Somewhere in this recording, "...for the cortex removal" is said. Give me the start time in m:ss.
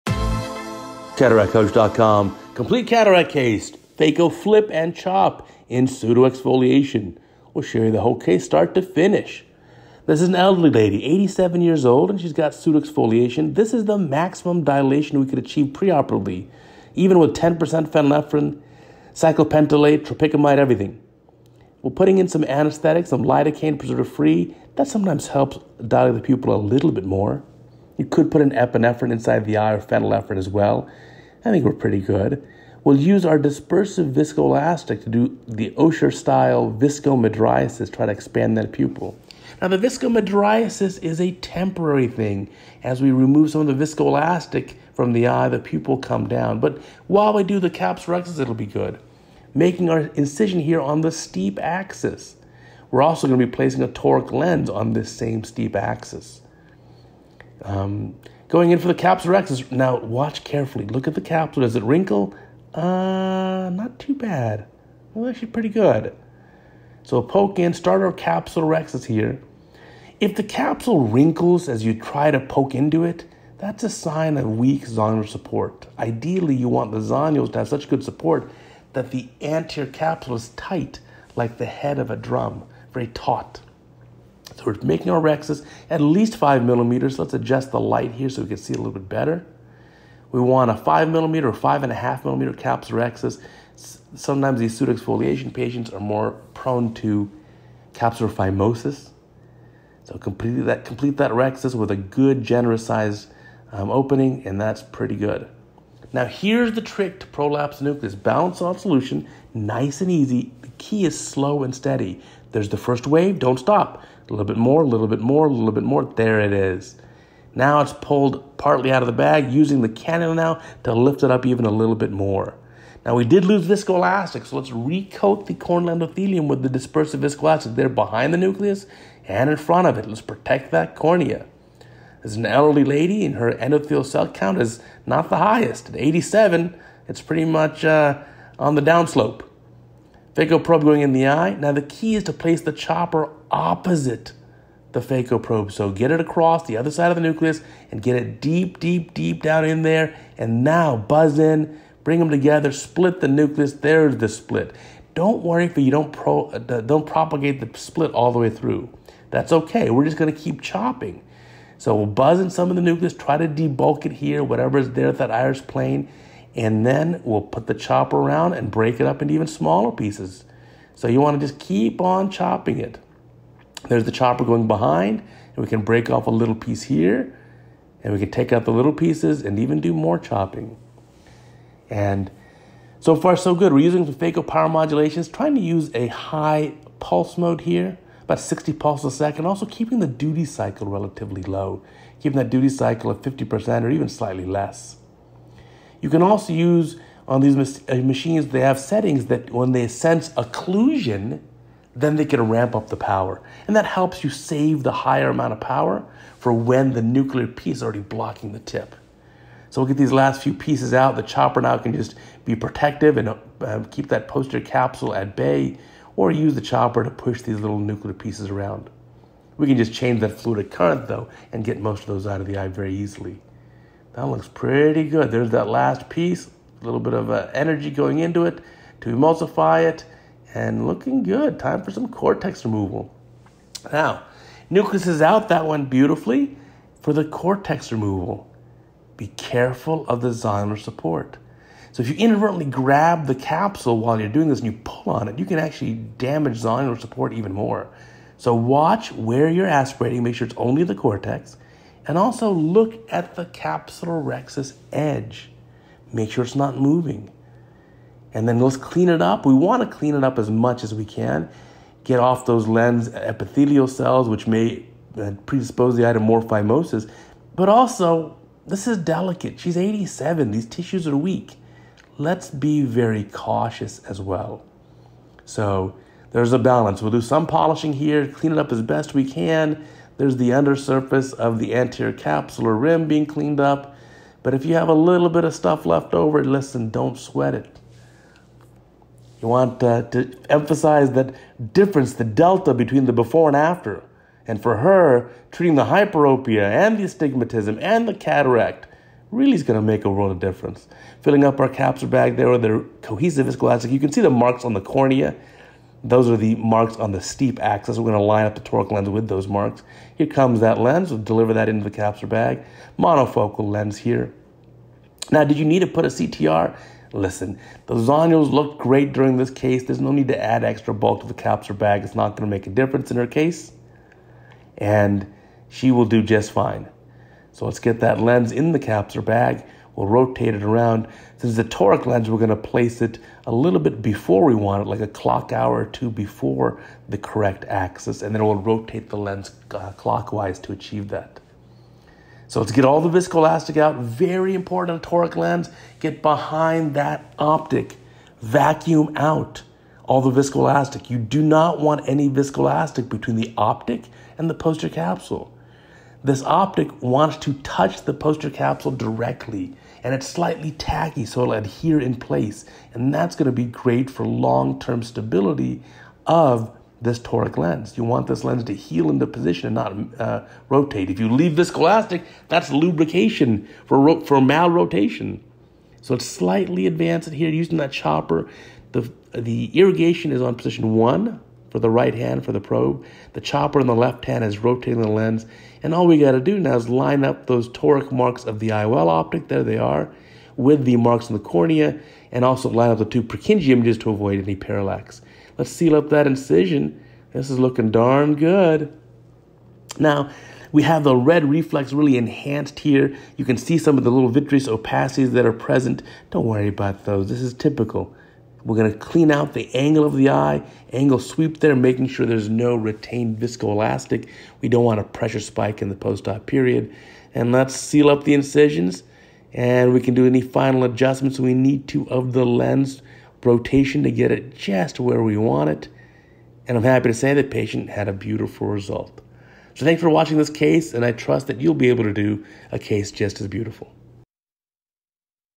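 3:57.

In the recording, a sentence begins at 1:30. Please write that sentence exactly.
We want a five millimeter or five and a half millimeter capsulorhexis.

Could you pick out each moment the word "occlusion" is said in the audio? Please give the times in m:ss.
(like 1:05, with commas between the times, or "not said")
3:20.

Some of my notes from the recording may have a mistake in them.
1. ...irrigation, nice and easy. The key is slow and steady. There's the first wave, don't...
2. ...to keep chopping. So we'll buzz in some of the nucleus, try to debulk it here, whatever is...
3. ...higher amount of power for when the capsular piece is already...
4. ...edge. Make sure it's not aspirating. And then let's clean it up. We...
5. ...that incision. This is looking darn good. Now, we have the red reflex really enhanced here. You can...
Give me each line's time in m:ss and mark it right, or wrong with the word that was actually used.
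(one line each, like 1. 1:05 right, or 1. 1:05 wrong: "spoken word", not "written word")
1. 1:48 wrong: "solution", not "irrigation"
2. 2:40 right
3. 3:24 wrong: "nuclear", not "capsular"
4. 4:14 wrong: "moving", not "aspirating"
5. 6:36 right.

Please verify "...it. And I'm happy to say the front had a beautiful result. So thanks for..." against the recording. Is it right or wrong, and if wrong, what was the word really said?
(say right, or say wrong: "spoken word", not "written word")
wrong: "patient", not "front".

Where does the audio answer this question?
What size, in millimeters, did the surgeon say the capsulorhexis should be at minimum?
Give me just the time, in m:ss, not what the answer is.
1:26.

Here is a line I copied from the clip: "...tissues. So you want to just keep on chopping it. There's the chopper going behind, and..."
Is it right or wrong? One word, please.
wrong.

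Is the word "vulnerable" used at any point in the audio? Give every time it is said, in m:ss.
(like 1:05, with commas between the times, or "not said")
not said.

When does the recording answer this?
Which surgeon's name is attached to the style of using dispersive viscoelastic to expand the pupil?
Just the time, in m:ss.
0:35.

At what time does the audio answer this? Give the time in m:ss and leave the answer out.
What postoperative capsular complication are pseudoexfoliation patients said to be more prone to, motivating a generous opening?
1:37.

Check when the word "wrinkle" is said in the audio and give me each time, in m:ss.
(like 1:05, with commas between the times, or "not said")
1:01, 1:11.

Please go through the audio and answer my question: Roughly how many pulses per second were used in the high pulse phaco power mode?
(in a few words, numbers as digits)
60.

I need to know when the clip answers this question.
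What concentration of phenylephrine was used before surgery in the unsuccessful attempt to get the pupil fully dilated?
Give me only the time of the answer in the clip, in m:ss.
0:17.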